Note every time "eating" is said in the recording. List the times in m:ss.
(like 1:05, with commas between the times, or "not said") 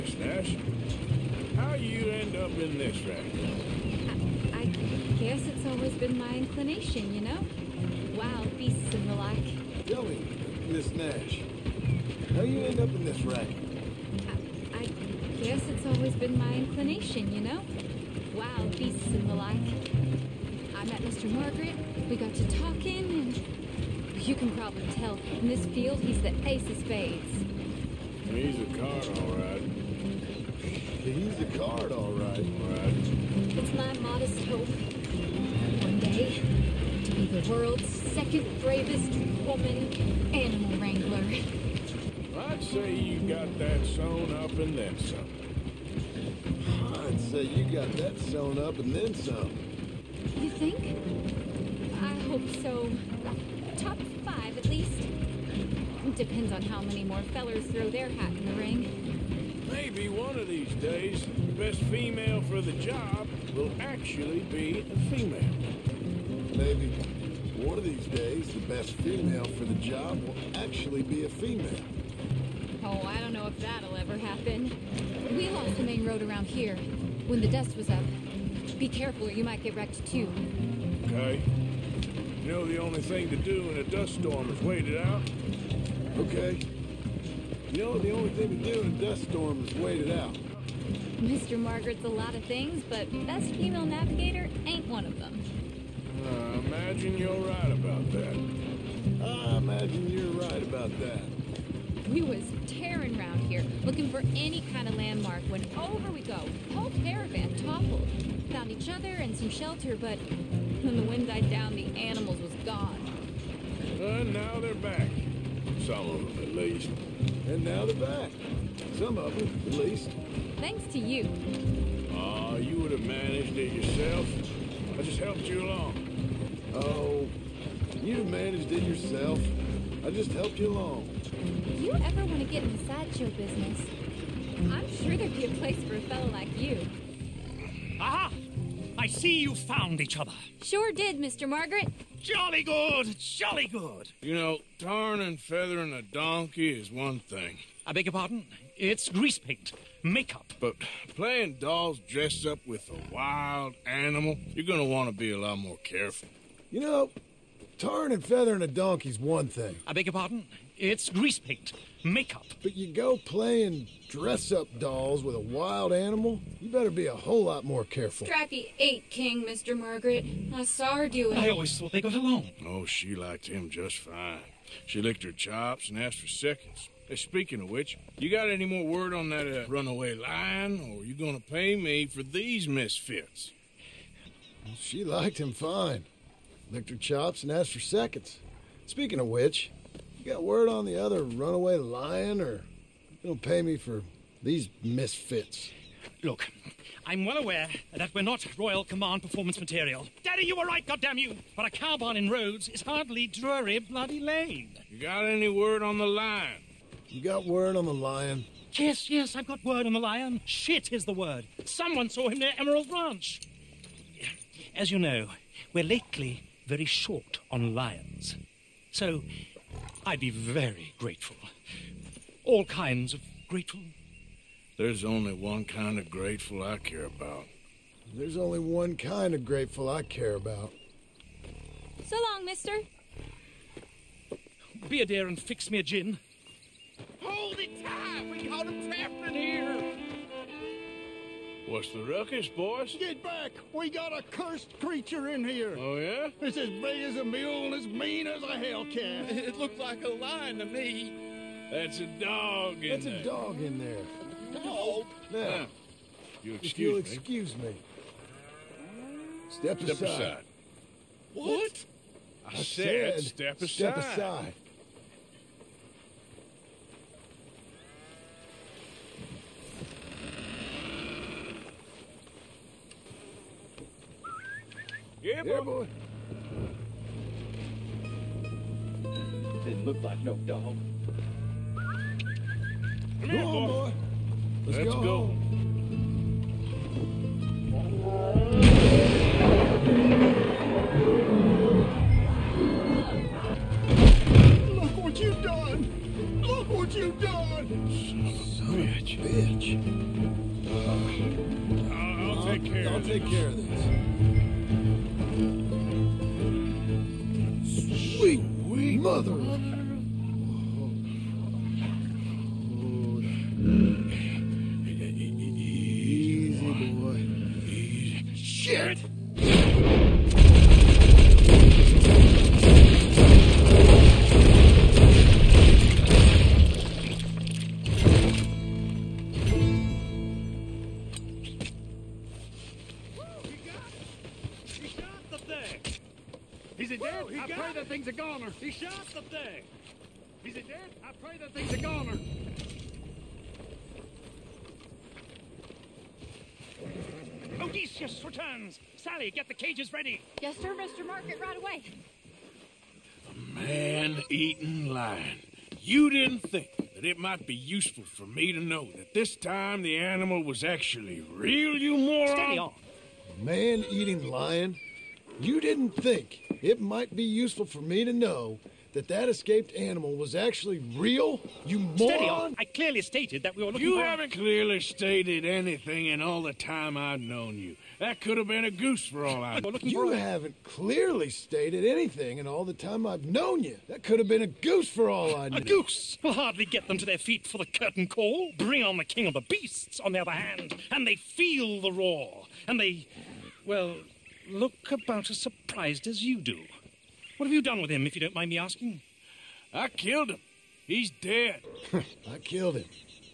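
5:53, 6:03.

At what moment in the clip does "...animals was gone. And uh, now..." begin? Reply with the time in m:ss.
1:51.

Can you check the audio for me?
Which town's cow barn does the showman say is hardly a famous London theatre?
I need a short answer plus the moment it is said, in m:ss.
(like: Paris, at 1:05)
Rhodes, at 3:22.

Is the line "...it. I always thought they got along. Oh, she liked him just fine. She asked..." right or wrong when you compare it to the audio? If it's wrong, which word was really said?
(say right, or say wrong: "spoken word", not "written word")
wrong: "licked", not "asked".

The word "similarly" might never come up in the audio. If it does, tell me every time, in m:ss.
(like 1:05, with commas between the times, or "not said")
not said.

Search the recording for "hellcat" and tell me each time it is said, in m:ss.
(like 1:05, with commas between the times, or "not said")
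4:08.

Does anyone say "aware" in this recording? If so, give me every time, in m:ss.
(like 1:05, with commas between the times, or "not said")
3:17.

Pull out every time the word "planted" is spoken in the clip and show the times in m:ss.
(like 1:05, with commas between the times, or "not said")
not said.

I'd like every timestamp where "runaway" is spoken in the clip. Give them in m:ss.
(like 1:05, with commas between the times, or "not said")
2:59, 3:11.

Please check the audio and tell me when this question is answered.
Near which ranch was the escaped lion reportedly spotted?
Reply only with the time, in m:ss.
3:32.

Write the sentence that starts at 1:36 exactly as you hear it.
I uh, imagine you're right about that.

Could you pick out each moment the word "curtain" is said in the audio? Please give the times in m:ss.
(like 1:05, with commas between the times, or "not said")
6:27.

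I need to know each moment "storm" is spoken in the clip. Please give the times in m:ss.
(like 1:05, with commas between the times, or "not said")
1:24, 1:29.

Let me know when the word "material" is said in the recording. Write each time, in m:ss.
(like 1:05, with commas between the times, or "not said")
3:19.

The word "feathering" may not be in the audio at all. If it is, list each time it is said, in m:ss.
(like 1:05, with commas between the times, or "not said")
2:25, 2:38.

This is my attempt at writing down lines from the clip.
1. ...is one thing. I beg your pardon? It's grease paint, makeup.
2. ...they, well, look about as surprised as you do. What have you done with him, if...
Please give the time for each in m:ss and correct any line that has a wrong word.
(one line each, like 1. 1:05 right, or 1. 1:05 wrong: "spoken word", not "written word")
1. 2:26 right
2. 6:32 right.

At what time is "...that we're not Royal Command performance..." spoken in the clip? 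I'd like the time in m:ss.
3:17.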